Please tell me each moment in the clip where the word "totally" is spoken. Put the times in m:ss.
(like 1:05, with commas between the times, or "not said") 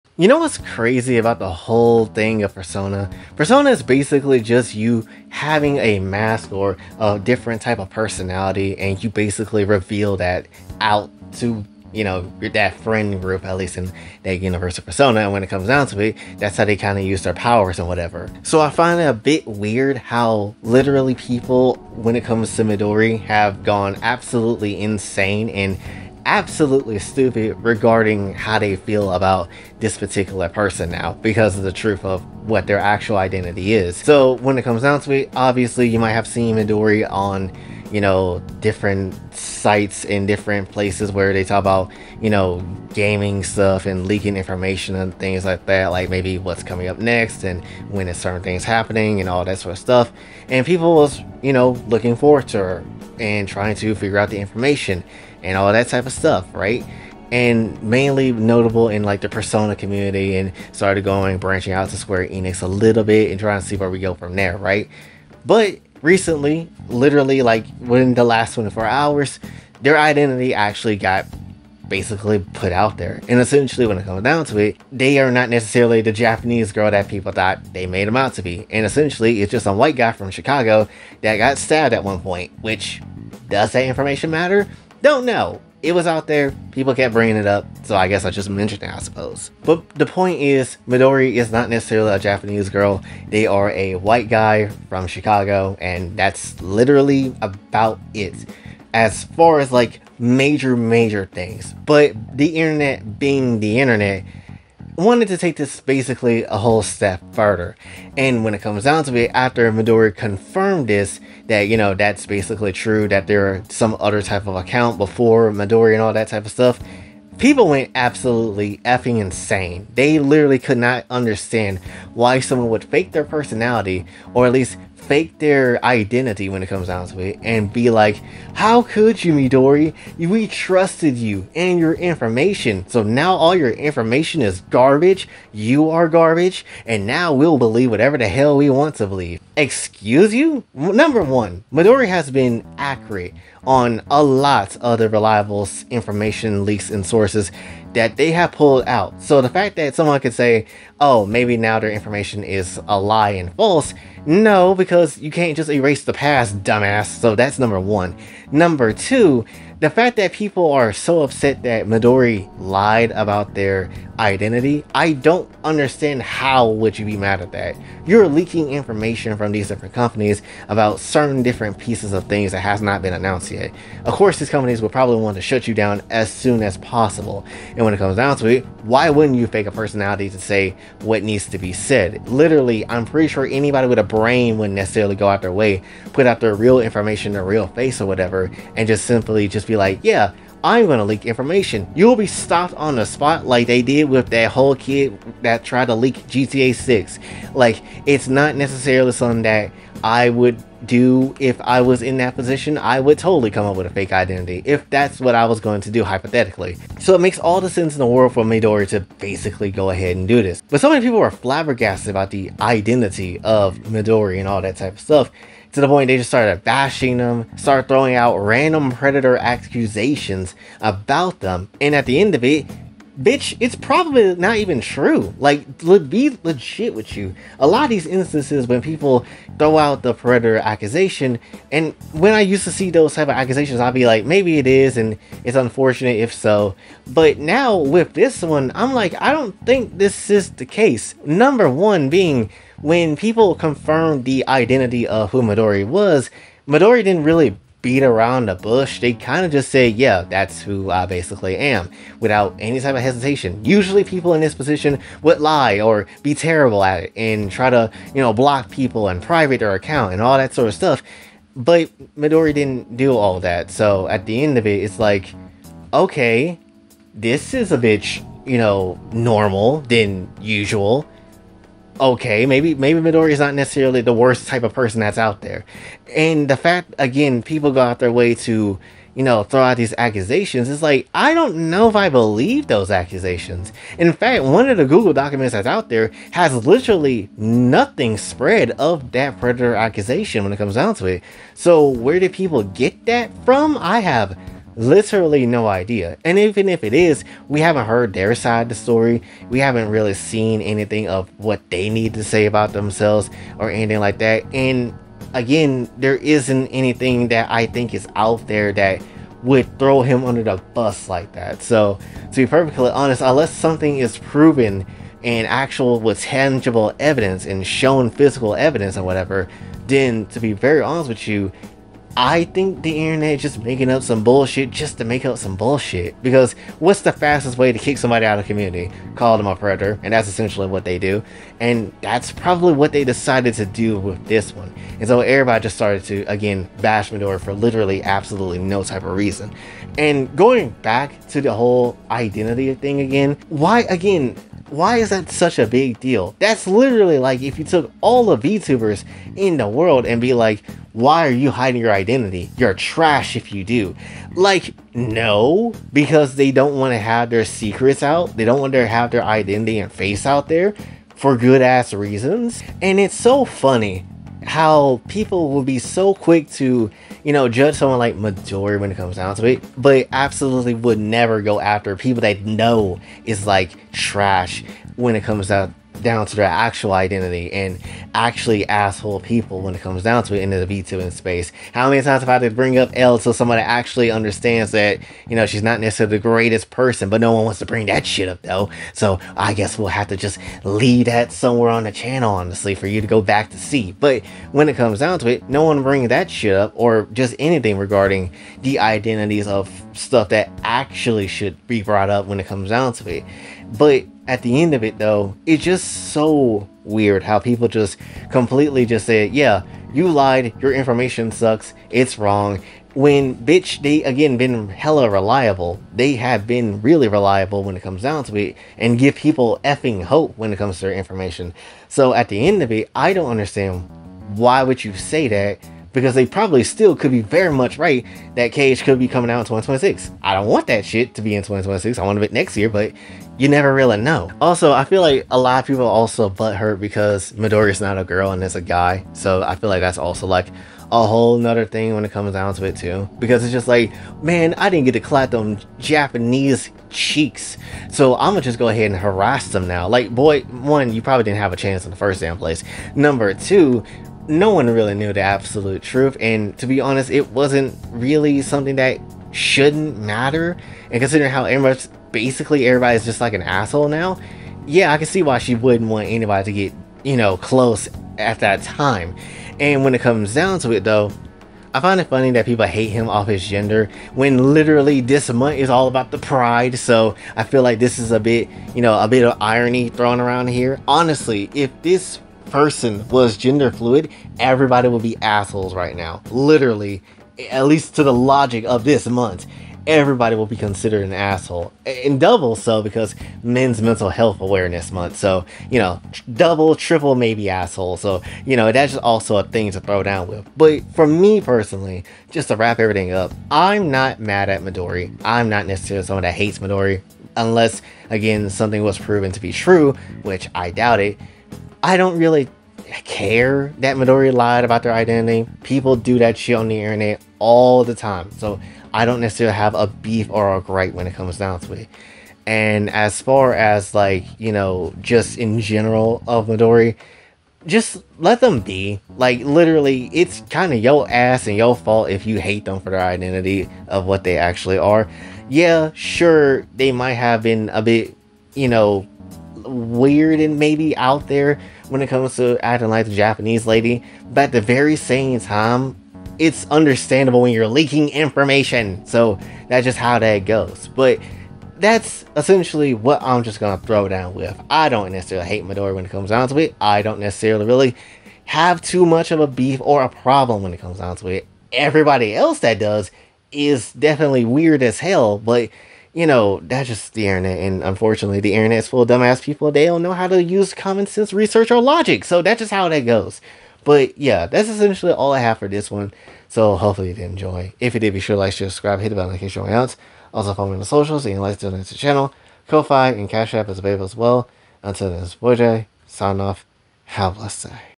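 3:23.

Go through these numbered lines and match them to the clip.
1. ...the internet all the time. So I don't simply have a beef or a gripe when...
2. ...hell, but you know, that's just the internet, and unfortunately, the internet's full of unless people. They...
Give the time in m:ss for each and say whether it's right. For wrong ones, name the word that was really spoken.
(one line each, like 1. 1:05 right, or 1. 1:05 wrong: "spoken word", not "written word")
1. 8:36 wrong: "necessarily", not "simply"
2. 9:24 wrong: "dumbass", not "unless".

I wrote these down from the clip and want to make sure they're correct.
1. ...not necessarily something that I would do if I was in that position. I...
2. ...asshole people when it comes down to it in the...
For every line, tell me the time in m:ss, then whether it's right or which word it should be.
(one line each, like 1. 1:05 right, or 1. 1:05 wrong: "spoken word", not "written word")
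1. 3:18 right
2. 6:18 right.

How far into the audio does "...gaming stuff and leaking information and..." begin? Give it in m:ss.
0:42.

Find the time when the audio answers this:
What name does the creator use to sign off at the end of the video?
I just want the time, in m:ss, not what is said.
9:45.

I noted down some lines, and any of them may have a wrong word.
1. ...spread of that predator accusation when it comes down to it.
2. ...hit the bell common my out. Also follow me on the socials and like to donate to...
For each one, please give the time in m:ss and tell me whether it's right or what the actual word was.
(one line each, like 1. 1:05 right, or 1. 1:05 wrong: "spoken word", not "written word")
1. 4:48 right
2. 9:38 wrong: "notification", not "common".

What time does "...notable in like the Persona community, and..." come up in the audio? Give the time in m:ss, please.
0:58.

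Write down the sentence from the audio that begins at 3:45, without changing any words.
Like, le- be legit with you.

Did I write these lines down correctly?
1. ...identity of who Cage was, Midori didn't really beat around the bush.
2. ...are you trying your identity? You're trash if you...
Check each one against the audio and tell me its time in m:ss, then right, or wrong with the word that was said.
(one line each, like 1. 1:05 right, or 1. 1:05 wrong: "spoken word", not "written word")
1. 4:04 wrong: "Midori", not "Cage"
2. 5:51 wrong: "hiding", not "trying".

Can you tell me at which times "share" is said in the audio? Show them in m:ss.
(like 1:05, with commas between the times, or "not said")
9:38.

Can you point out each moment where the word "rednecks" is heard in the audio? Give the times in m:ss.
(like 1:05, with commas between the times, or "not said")
not said.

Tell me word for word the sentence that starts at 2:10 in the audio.
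We trusted you and your information.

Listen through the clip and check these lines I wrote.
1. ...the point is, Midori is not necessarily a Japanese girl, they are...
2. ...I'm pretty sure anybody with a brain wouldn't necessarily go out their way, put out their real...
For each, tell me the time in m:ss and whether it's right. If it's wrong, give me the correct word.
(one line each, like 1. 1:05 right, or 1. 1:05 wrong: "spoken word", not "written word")
1. 1:29 right
2. 3:02 right.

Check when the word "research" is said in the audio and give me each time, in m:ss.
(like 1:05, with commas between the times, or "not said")
9:31.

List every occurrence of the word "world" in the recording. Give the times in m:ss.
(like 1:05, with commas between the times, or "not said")
3:28, 5:49.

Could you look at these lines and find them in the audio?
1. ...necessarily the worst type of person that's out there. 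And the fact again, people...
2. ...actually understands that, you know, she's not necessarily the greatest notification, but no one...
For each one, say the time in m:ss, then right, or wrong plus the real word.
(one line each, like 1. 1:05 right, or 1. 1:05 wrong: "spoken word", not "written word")
1. 4:33 right
2. 6:23 wrong: "person", not "notification".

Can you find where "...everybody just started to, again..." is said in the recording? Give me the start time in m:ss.
5:35.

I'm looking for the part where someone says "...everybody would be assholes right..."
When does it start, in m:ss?
8:04.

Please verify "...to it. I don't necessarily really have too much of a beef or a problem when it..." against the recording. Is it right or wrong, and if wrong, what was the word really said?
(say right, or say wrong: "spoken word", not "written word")
right.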